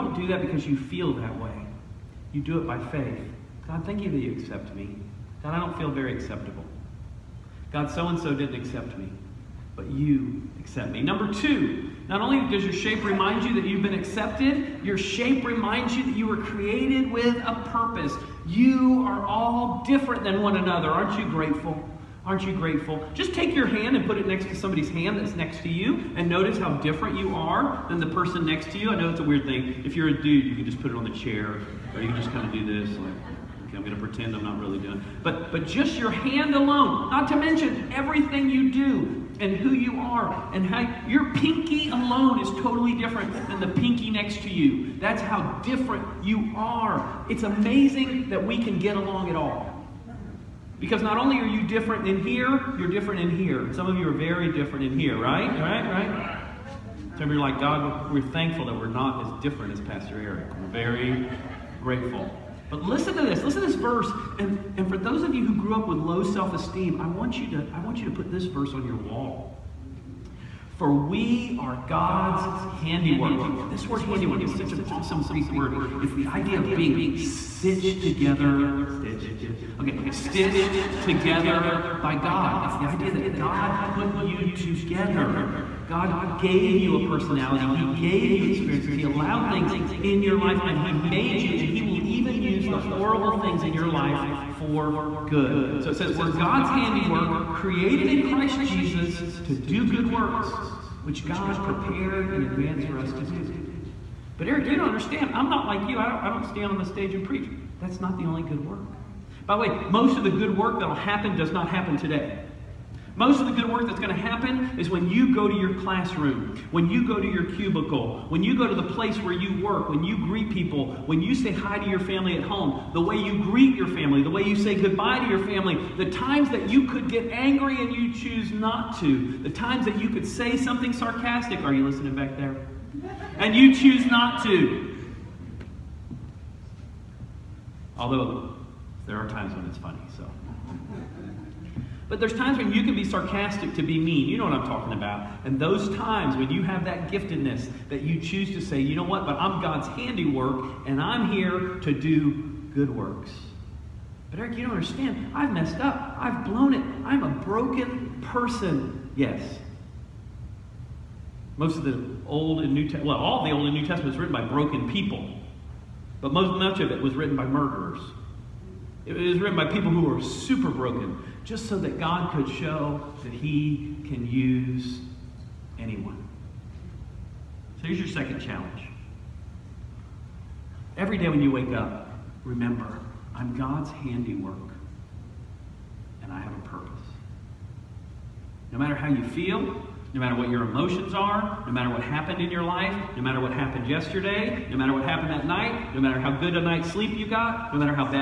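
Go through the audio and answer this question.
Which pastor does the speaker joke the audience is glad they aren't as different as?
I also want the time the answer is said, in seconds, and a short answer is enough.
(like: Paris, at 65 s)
Pastor Eric, at 59 s.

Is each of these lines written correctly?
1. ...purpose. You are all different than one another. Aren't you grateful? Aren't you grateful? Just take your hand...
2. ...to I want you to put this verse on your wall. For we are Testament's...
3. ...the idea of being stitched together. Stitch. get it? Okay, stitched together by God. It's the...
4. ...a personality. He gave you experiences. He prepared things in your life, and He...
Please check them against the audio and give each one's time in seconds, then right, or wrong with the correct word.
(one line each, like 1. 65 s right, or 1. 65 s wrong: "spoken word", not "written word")
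1. 17 s right
2. 67 s wrong: "God", not "Testament"
3. 76 s right
4. 86 s wrong: "allowed", not "prepared".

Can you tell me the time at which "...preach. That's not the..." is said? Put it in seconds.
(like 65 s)
107 s.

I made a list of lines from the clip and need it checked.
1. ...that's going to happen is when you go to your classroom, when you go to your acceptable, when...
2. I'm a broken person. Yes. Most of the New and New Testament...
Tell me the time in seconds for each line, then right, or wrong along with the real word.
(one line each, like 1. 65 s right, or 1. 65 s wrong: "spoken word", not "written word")
1. 113 s wrong: "cubicle", not "acceptable"
2. 157 s wrong: "Old", not "New".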